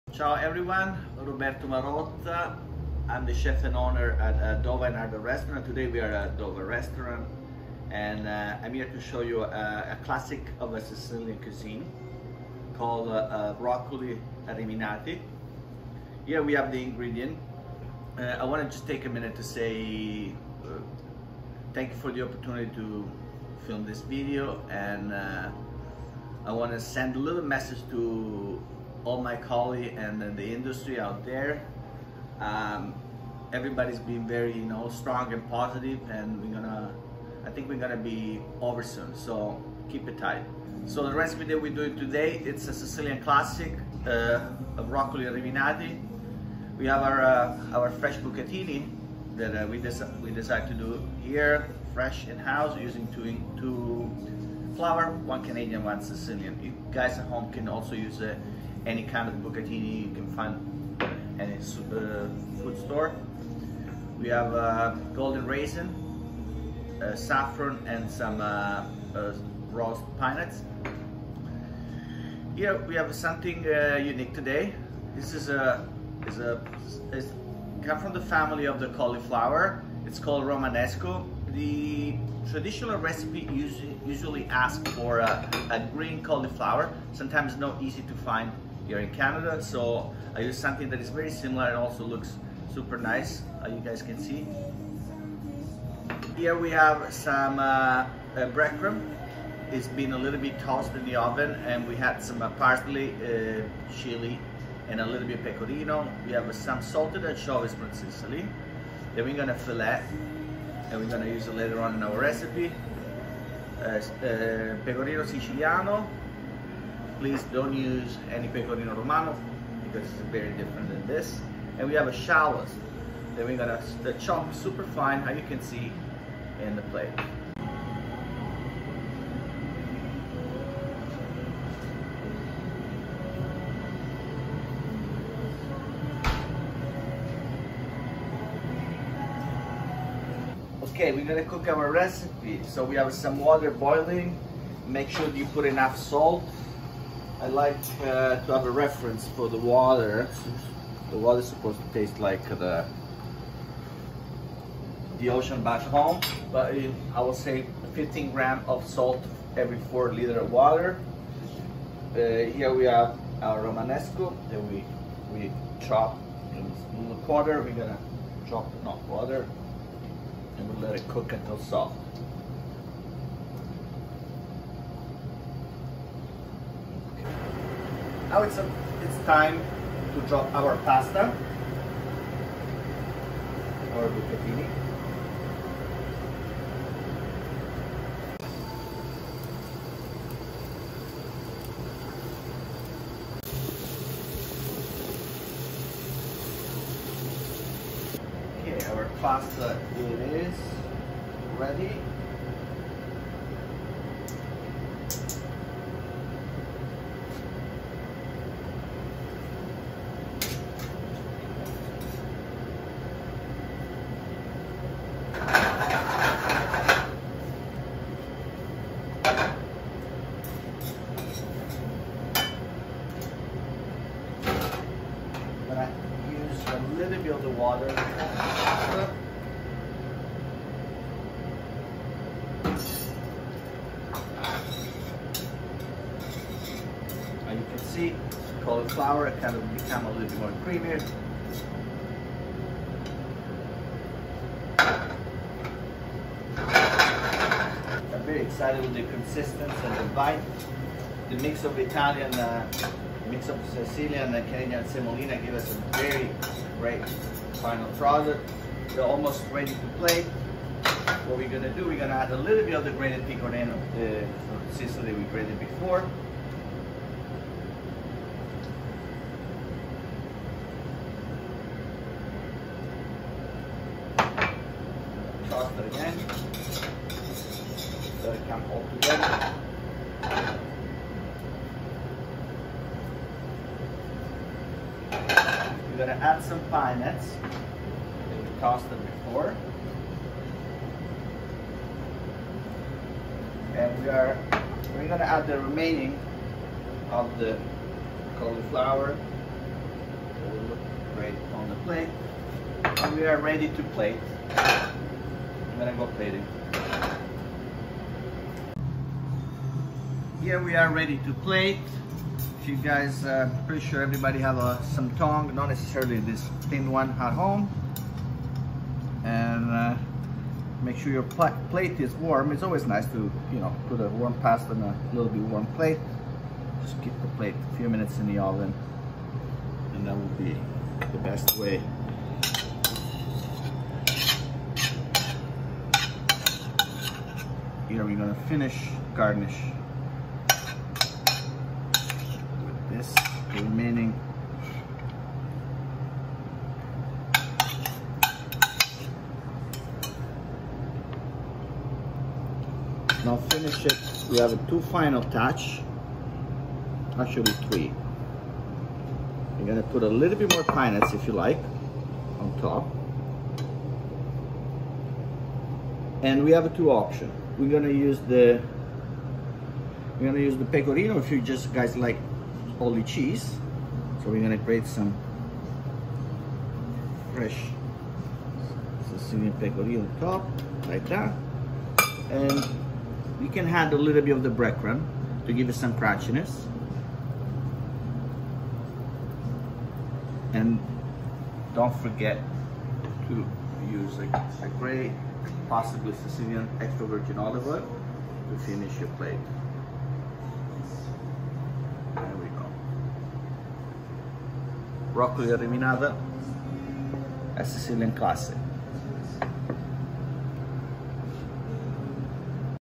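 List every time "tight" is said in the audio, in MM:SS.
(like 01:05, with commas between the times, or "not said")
00:40.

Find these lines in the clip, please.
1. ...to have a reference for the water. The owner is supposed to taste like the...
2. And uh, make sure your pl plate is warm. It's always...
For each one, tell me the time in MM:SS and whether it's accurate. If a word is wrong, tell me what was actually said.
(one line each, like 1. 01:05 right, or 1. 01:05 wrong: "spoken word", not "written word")
1. 02:28 wrong: "water", not "owner"
2. 05:19 right.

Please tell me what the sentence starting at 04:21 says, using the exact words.
What we're gonna do, we're gonna add a little bit of the grated pecorino the Sicily that we grated before.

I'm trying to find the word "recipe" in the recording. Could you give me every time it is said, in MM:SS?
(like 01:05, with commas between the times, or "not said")
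00:41, 01:22, 01:52, 02:21.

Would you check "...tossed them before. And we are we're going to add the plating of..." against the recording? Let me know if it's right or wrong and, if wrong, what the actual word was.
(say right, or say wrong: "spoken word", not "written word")
wrong: "remaining", not "plating".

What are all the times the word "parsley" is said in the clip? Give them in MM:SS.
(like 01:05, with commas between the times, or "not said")
01:42.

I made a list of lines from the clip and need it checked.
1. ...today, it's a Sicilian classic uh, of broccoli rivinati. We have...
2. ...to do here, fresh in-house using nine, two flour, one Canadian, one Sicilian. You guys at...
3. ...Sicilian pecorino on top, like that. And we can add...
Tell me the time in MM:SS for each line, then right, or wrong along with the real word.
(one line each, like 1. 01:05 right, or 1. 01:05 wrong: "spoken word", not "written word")
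1. 00:41 right
2. 00:50 wrong: "two", not "nine"
3. 06:19 right.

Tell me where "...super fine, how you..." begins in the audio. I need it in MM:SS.
02:04.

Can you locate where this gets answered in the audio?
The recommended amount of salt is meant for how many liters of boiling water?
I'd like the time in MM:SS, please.
02:39.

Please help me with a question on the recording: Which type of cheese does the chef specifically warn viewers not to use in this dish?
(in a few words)
pecorino romano.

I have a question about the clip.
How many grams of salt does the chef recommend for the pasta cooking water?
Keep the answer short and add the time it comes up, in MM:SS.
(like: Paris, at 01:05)
15 grams, at 02:37.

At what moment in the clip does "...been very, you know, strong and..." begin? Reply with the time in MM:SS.
00:33.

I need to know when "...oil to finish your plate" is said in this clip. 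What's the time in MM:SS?
06:37.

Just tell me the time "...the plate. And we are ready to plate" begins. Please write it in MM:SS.
05:01.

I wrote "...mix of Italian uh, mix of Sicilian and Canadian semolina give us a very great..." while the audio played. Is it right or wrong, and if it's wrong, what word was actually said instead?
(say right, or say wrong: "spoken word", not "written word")
right.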